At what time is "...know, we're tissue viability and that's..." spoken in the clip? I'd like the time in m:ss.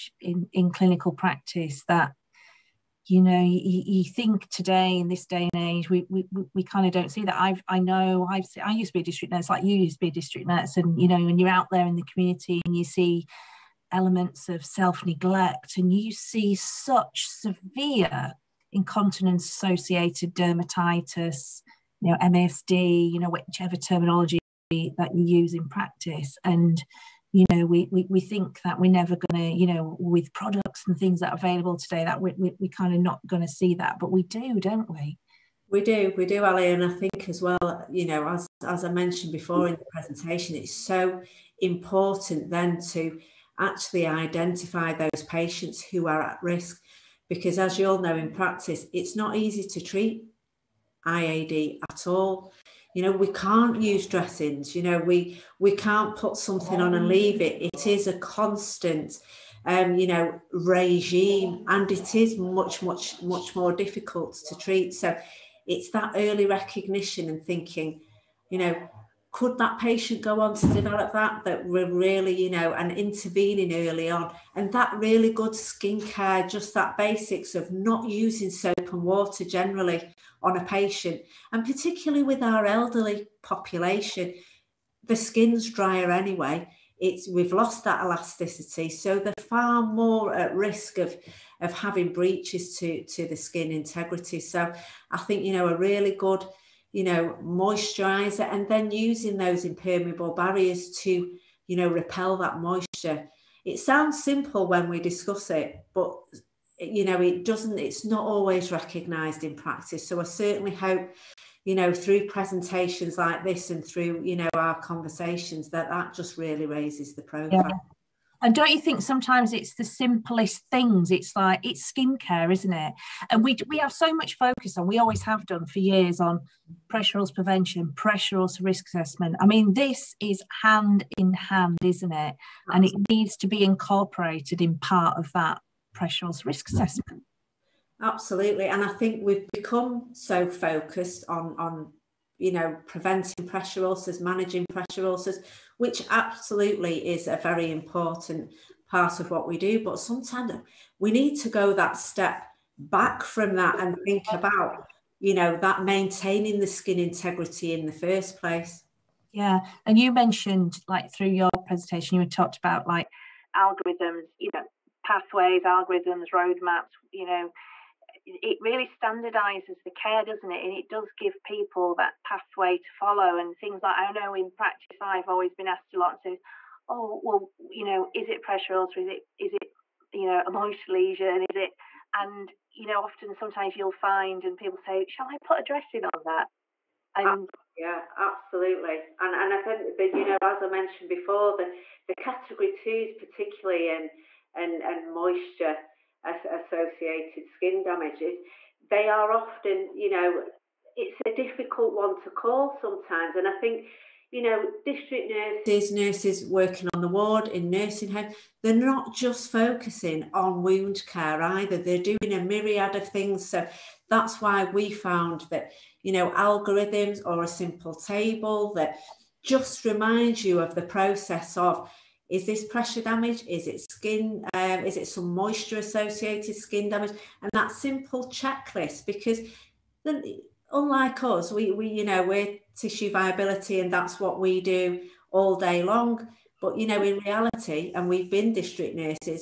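3:52.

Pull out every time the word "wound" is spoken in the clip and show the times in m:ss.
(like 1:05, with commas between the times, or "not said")
3:30.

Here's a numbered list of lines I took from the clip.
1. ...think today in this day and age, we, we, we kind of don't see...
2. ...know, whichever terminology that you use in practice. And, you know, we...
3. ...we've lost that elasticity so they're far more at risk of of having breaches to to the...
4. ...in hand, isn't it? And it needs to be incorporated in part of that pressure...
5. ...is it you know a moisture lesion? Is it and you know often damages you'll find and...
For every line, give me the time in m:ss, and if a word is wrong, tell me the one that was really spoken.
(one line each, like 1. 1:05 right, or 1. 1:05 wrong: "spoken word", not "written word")
1. 0:04 right
2. 0:23 right
3. 1:27 right
4. 2:11 right
5. 2:59 wrong: "sometimes", not "damages".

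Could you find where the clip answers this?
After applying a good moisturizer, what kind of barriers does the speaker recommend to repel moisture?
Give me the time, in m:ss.
1:39.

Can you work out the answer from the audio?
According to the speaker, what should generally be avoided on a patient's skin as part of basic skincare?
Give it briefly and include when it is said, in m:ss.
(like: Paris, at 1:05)
Soap and water, at 1:18.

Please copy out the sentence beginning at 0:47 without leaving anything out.
Because as you all know in practice, it's not easy to treat IAD at all.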